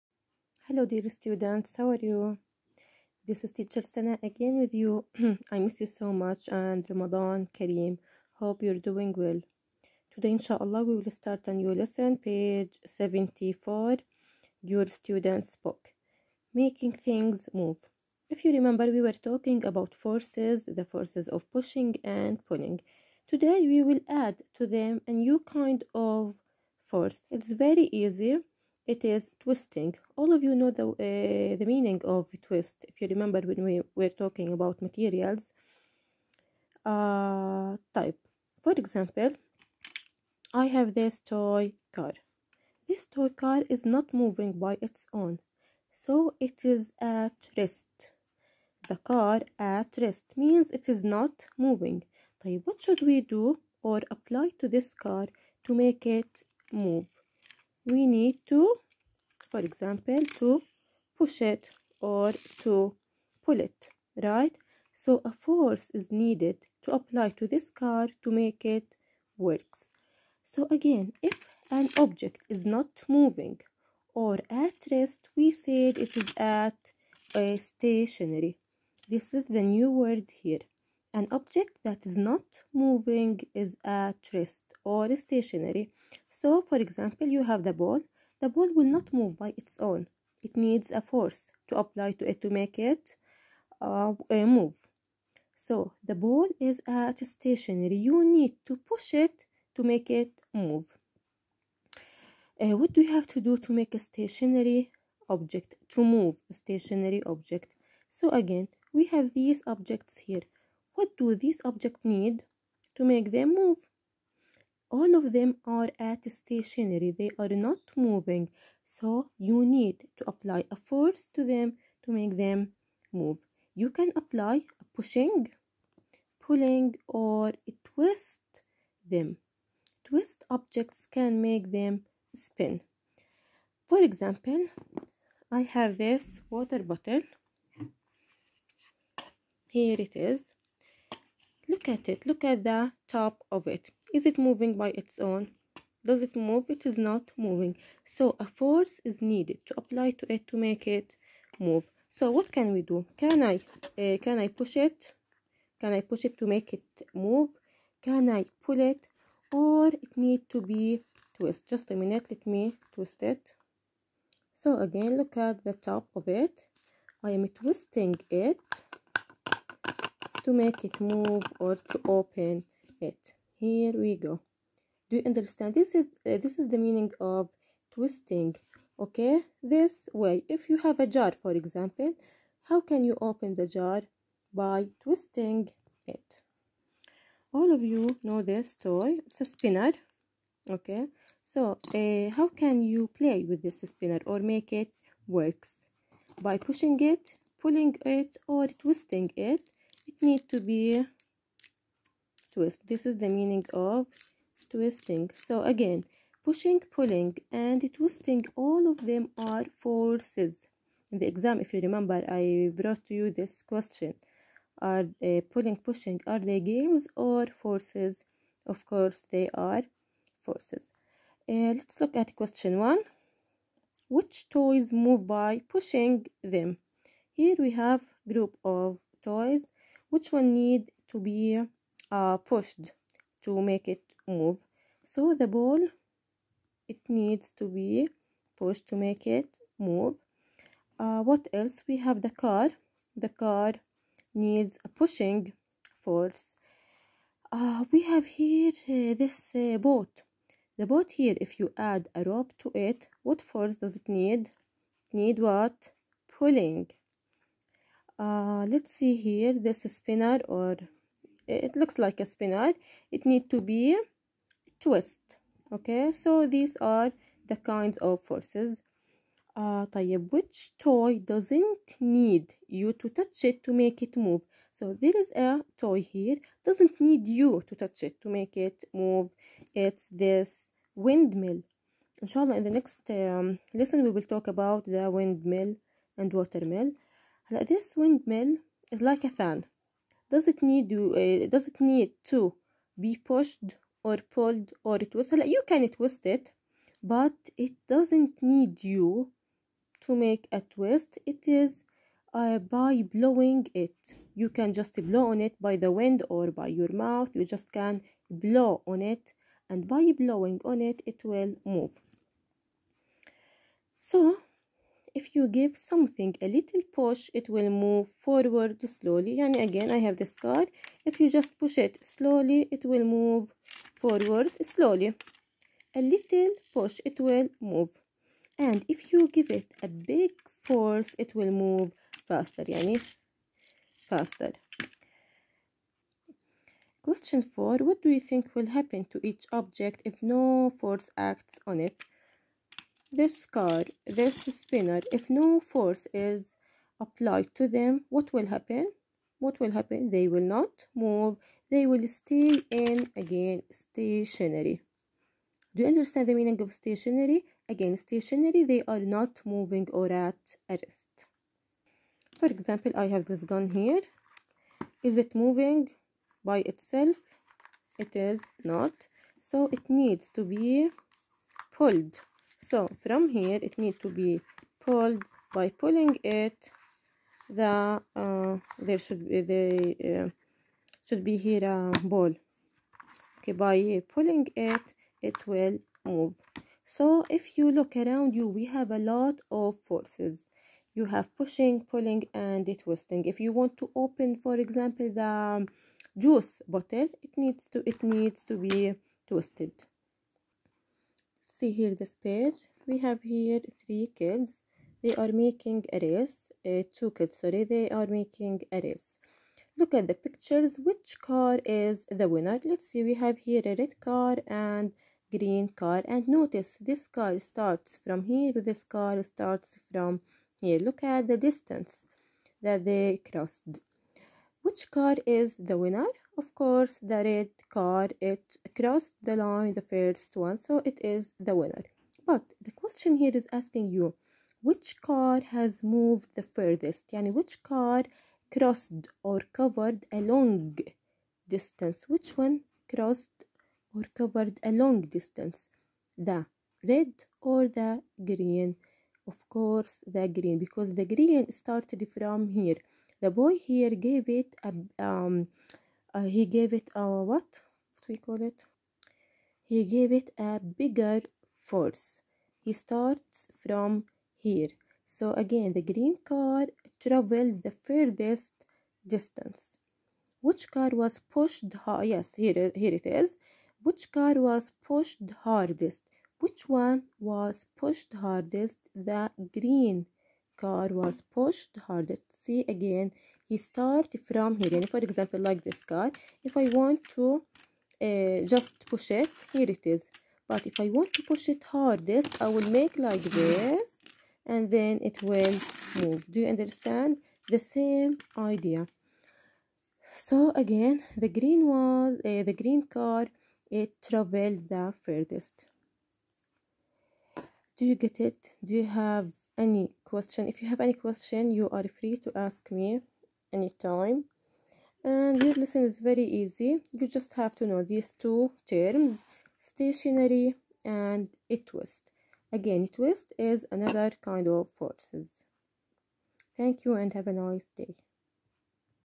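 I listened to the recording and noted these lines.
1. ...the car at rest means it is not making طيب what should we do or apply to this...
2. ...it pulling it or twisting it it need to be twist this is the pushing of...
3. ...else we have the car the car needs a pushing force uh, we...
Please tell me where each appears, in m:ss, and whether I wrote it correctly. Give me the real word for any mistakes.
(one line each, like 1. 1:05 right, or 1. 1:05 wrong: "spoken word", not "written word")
1. 0:48 wrong: "moving", not "making"
2. 3:16 wrong: "meaning", not "pushing"
3. 4:01 right.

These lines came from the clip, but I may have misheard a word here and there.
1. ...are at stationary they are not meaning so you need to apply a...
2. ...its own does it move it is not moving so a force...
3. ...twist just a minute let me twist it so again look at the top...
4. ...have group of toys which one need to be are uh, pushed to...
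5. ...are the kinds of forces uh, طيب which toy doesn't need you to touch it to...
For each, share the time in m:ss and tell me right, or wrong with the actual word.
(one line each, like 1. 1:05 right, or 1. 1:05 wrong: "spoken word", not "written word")
1. 1:55 wrong: "moving", not "meaning"
2. 2:25 right
3. 2:41 right
4. 3:47 right
5. 4:26 right.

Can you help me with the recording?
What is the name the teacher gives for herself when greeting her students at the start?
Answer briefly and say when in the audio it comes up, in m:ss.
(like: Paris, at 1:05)
Sana, at 0:03.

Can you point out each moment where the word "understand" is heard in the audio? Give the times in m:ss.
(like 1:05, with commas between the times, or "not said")
2:55, 5:55, 8:16.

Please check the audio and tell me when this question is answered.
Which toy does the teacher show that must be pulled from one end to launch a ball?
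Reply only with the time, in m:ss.
6:03.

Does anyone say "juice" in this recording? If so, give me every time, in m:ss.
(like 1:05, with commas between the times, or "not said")
6:36.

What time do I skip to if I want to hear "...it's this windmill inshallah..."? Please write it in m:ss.
4:39.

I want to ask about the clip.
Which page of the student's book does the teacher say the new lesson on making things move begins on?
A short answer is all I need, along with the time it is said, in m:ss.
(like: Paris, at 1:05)
74, at 0:12.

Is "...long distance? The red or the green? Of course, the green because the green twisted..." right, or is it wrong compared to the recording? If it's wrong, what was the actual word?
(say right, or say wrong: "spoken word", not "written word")
wrong: "started", not "twisted".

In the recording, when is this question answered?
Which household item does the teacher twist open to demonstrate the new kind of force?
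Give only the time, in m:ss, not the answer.
2:16.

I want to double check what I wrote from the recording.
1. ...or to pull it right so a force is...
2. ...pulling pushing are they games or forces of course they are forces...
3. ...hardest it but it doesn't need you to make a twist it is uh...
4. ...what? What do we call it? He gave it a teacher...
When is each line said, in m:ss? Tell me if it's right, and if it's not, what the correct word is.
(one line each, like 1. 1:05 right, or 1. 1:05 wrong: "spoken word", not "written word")
1. 1:01 right
2. 3:35 right
3. 4:55 wrong: "twist", not "hardest"
4. 7:37 wrong: "bigger", not "teacher".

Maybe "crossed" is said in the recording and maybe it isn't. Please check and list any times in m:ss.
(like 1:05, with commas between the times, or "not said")
7:03, 7:08, 7:18, 7:22.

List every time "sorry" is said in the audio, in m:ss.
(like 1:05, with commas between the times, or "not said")
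6:47.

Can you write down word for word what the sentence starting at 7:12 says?
But the question here is asking you which car has moved the furthest?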